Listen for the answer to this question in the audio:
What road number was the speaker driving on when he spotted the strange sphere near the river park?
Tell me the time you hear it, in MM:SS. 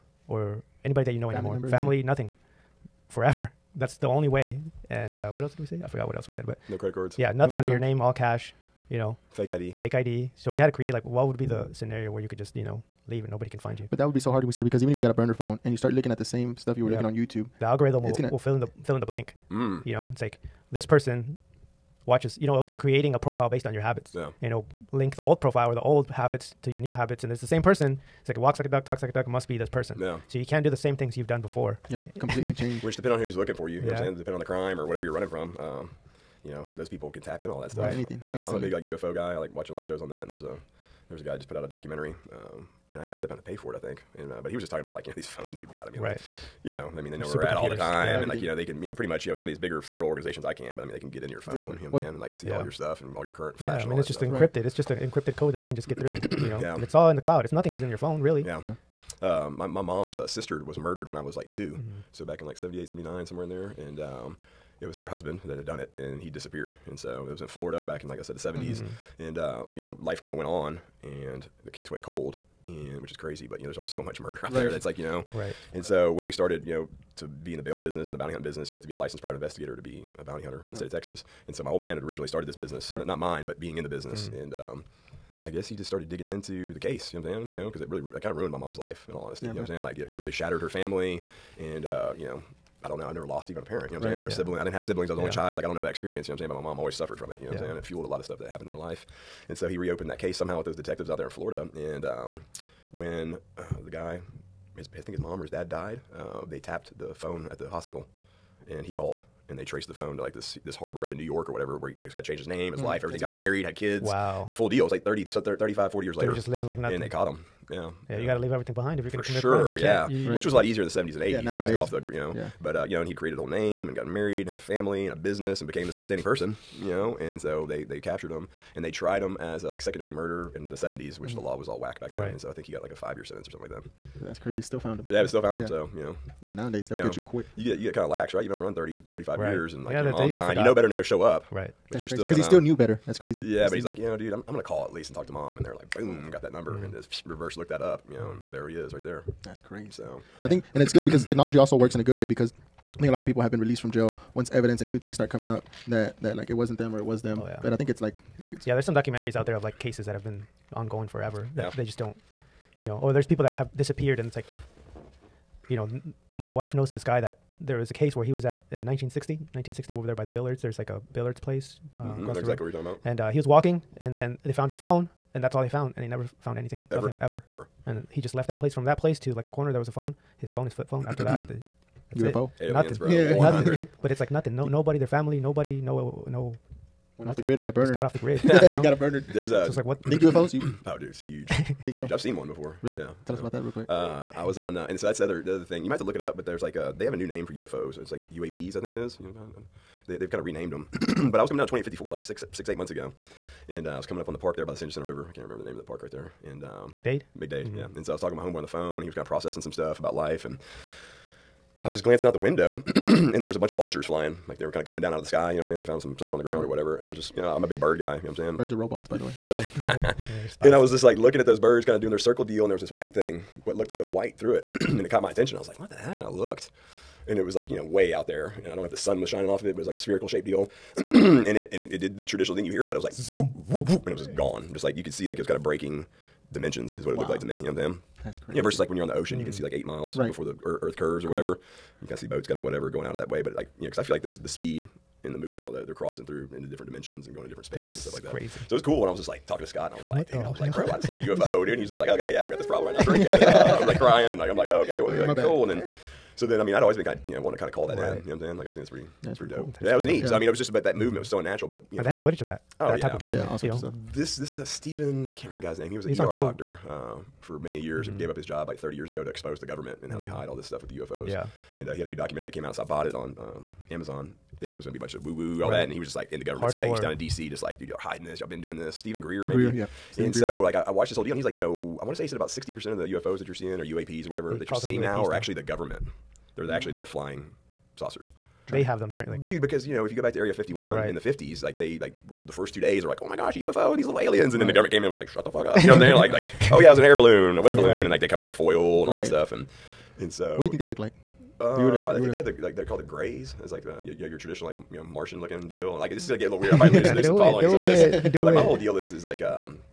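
03:21.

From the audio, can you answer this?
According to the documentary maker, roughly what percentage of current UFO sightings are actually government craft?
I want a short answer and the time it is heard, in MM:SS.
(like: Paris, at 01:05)
60%, at 04:42.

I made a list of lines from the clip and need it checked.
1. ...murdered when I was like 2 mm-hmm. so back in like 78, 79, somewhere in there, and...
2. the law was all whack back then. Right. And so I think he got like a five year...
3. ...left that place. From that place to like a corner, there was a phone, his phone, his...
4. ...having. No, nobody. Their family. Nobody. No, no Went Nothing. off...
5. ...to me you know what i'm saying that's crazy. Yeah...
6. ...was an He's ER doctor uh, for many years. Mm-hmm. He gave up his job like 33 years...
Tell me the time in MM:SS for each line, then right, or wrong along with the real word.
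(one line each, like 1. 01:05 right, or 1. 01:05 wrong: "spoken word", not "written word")
1. 01:00 right
2. 02:11 right
3. 02:58 right
4. 03:04 wrong: "nothing", not "having"
5. 03:57 right
6. 04:25 wrong: "30", not "33".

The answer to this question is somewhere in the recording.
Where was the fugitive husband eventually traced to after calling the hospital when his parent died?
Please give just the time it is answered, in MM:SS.
01:51.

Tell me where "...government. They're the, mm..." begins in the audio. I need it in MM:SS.
04:45.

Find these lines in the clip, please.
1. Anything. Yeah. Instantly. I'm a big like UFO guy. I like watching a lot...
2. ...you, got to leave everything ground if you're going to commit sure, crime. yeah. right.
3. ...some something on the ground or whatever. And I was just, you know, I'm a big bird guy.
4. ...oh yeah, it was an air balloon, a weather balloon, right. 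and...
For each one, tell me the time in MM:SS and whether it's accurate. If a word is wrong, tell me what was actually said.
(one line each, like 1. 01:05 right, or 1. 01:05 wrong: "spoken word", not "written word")
1. 00:37 right
2. 01:58 wrong: "behind", not "ground"
3. 03:36 right
4. 04:56 right.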